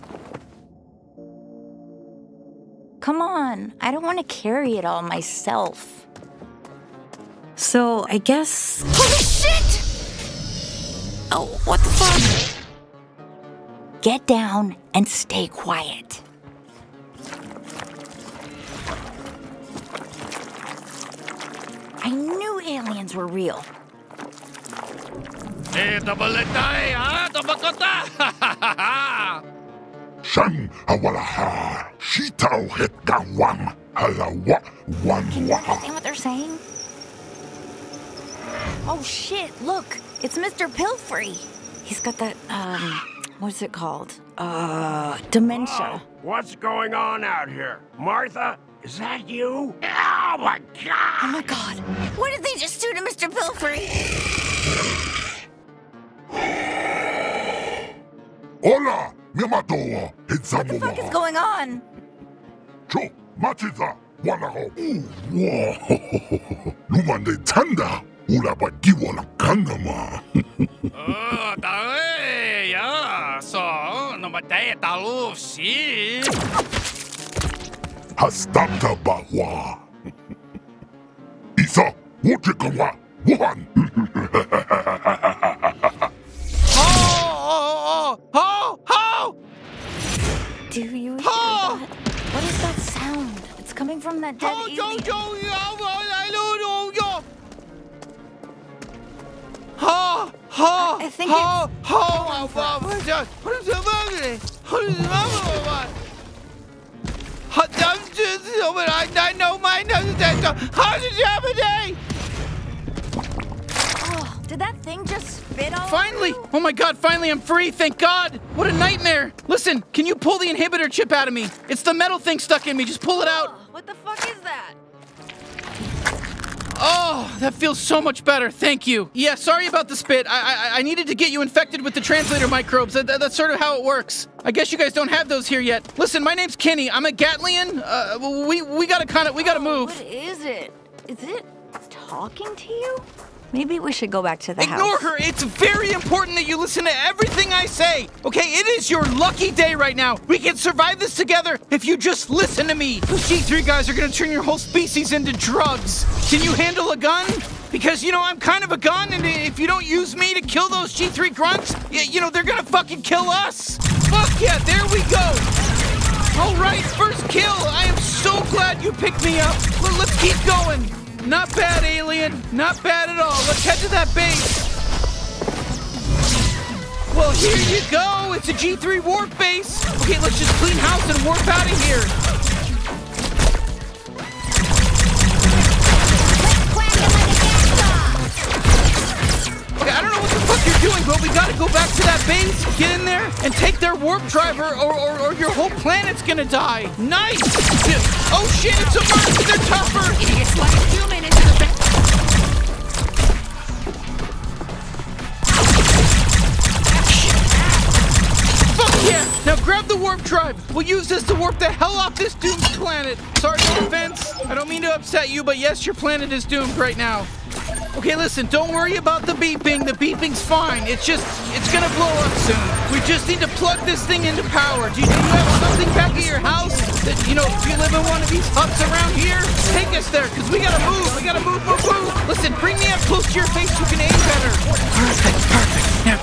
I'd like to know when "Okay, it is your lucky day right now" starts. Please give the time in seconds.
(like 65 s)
148 s.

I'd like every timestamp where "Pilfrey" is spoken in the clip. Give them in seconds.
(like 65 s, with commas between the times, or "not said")
40 s, 53 s.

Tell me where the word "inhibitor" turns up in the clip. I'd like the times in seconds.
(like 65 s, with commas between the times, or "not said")
120 s.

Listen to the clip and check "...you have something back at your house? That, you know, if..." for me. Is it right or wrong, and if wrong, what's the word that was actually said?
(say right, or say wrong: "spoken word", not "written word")
right.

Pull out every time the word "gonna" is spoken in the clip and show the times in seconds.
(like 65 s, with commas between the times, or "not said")
153 s, 162 s, 196 s, 221 s.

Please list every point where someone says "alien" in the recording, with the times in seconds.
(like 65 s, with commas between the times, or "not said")
94 s, 171 s.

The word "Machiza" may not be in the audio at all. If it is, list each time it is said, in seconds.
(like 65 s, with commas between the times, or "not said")
63 s.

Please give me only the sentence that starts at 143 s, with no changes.
Maybe we should go back to the Ignore house.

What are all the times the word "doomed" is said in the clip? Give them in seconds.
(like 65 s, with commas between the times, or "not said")
212 s, 216 s.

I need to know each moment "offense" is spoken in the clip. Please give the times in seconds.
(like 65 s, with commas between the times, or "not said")
213 s.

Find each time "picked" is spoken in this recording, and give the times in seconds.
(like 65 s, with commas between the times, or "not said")
168 s.